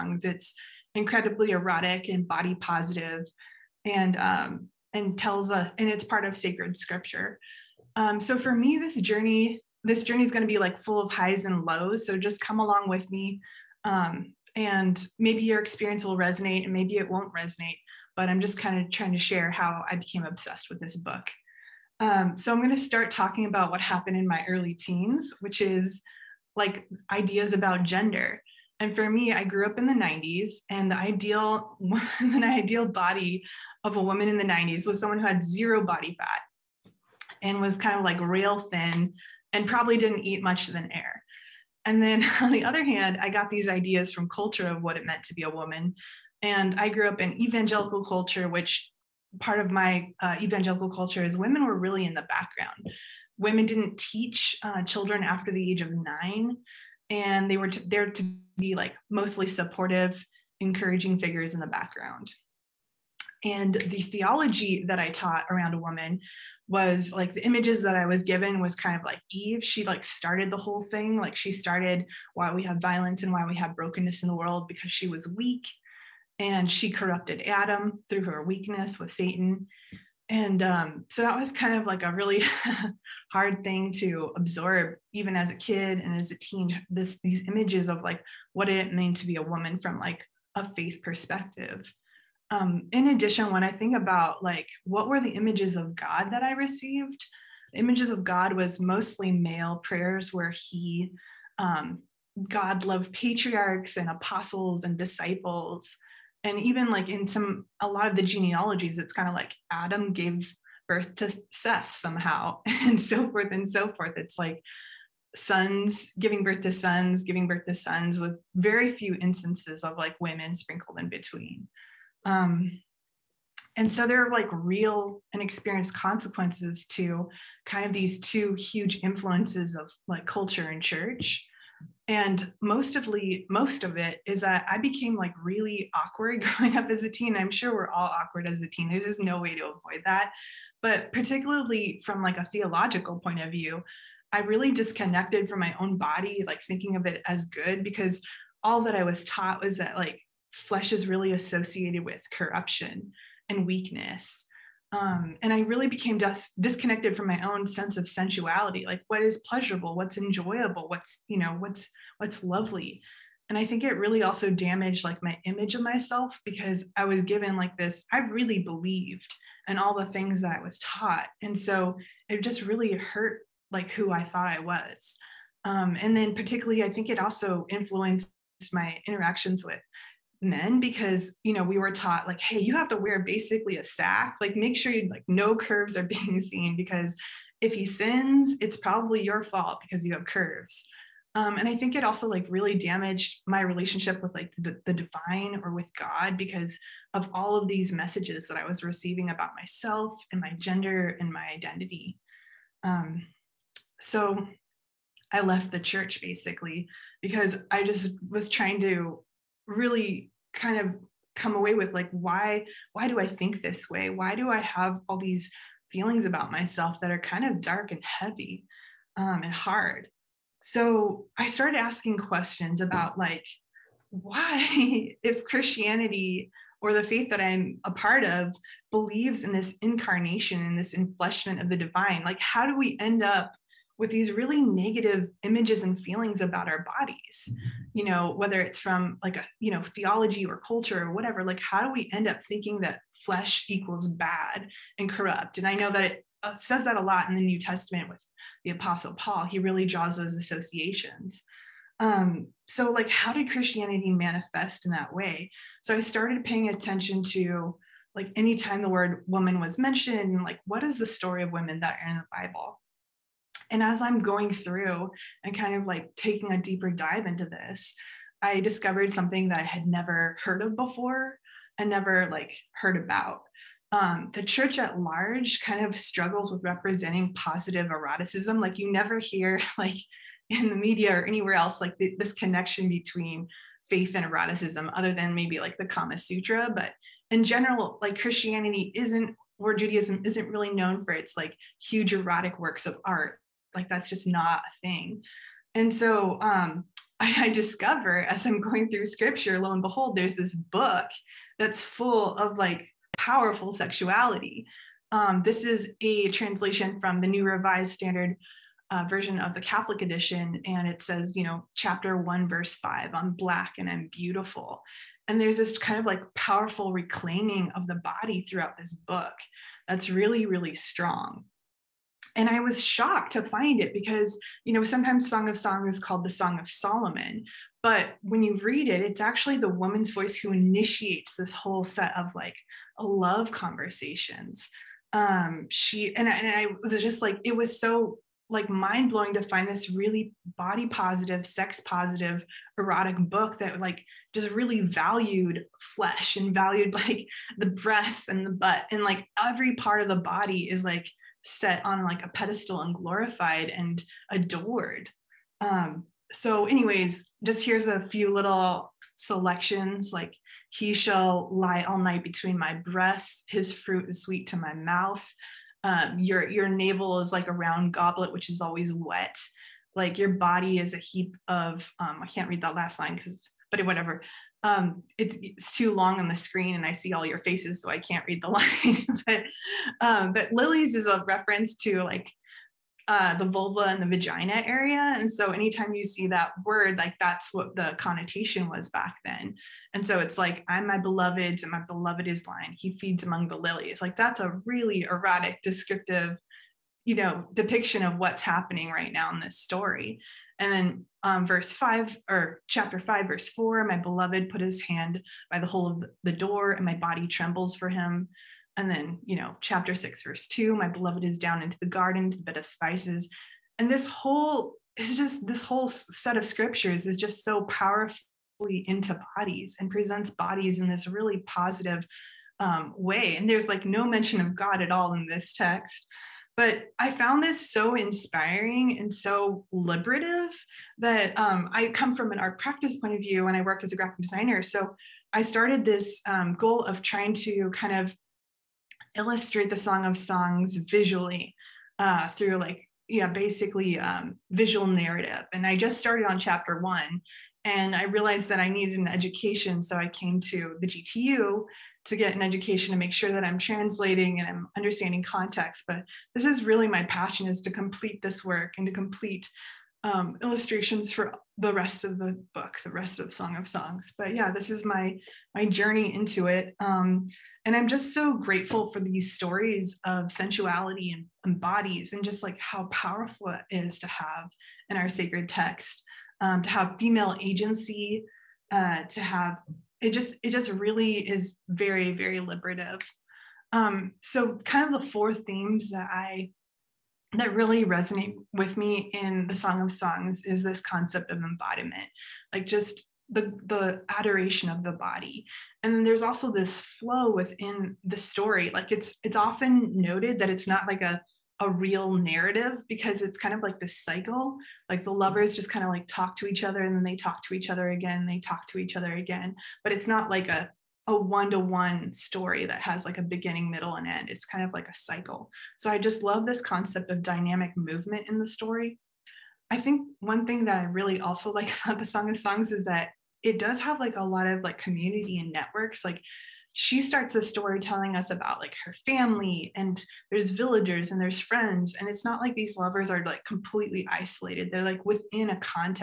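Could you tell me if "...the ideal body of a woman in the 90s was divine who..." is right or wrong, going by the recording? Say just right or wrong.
wrong.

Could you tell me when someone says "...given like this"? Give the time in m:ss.
2:47.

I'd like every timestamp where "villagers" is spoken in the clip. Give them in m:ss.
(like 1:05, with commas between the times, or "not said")
8:50.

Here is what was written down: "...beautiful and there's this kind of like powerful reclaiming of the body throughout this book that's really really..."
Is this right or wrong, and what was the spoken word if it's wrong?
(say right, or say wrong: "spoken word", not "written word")
right.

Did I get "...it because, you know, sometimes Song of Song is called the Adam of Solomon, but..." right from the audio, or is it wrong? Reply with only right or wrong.
wrong.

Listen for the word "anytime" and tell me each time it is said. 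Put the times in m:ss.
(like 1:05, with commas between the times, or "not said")
4:18, 6:25.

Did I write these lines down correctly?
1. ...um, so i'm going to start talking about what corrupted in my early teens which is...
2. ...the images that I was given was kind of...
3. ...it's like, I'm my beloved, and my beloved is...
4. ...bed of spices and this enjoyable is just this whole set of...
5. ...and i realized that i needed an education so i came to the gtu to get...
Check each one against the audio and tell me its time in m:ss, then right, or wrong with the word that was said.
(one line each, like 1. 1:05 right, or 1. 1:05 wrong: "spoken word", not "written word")
1. 0:21 wrong: "happened", not "corrupted"
2. 1:07 right
3. 6:30 right
4. 6:52 wrong: "whole", not "enjoyable"
5. 7:27 right.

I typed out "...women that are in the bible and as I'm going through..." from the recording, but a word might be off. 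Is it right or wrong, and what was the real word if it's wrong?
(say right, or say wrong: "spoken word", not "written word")
right.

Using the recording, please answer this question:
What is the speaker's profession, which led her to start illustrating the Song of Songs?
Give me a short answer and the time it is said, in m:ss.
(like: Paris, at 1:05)
graphic designer, at 7:13.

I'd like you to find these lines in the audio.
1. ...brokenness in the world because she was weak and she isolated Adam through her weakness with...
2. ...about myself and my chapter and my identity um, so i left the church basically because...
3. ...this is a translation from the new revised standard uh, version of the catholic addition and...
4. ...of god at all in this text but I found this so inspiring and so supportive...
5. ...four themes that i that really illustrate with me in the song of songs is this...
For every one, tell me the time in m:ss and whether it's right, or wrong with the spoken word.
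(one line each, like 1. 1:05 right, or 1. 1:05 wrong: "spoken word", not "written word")
1. 1:13 wrong: "corrupted", not "isolated"
2. 3:19 wrong: "gender", not "chapter"
3. 5:05 wrong: "edition", not "addition"
4. 7:04 wrong: "liberative", not "supportive"
5. 8:05 wrong: "resonate", not "illustrate".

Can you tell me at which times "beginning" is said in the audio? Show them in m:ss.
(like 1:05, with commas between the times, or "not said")
8:33.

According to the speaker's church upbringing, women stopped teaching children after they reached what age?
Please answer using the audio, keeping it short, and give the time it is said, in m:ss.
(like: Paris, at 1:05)
9, at 0:55.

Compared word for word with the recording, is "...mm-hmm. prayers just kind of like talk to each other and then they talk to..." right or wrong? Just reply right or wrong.
wrong.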